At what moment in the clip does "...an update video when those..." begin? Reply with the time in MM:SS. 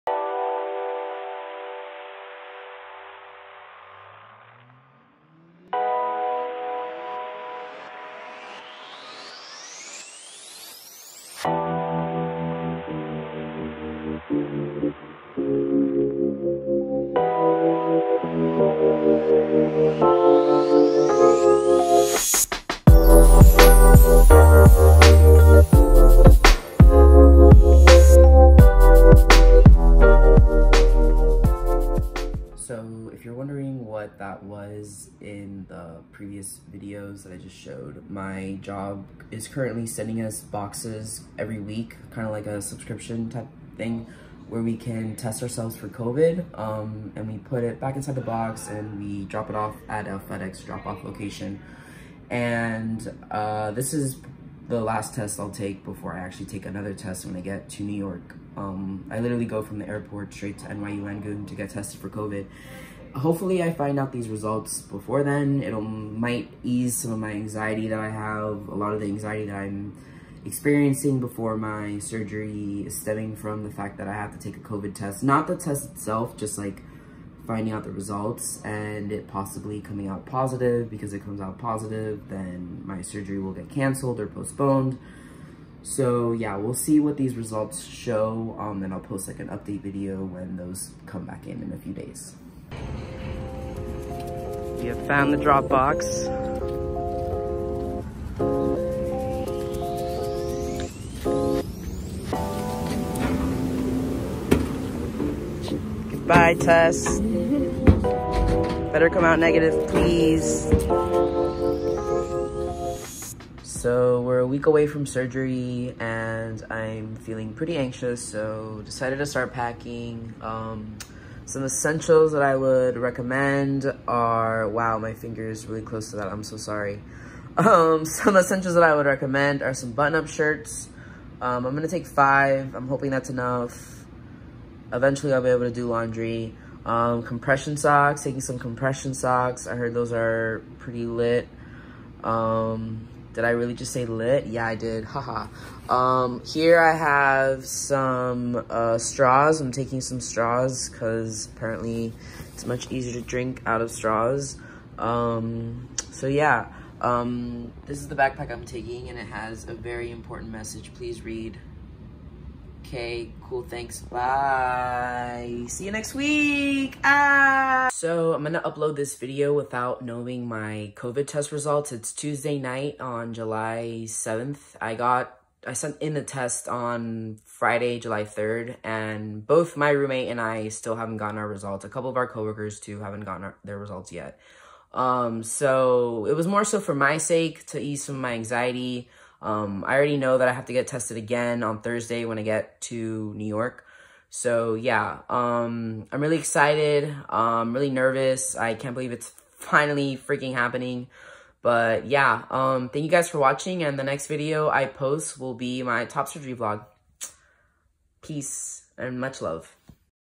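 01:29.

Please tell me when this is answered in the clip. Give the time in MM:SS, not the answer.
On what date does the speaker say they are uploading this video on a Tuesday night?
02:53.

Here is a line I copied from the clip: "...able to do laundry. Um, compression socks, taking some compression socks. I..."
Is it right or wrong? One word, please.
right.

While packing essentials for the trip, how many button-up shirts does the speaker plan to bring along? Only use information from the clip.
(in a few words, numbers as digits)
5.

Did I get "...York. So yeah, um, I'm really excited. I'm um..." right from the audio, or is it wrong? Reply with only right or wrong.
right.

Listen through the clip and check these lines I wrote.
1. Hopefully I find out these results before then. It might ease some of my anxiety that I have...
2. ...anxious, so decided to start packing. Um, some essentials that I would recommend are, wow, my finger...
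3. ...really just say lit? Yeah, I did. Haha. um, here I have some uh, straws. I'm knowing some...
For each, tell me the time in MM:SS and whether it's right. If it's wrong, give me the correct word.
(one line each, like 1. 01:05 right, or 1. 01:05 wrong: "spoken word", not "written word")
1. 01:03 right
2. 01:57 right
3. 02:23 wrong: "taking", not "knowing".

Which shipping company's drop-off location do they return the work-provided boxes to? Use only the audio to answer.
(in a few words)
FedEx.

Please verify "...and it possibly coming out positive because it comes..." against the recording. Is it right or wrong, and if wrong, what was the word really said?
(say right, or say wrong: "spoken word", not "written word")
right.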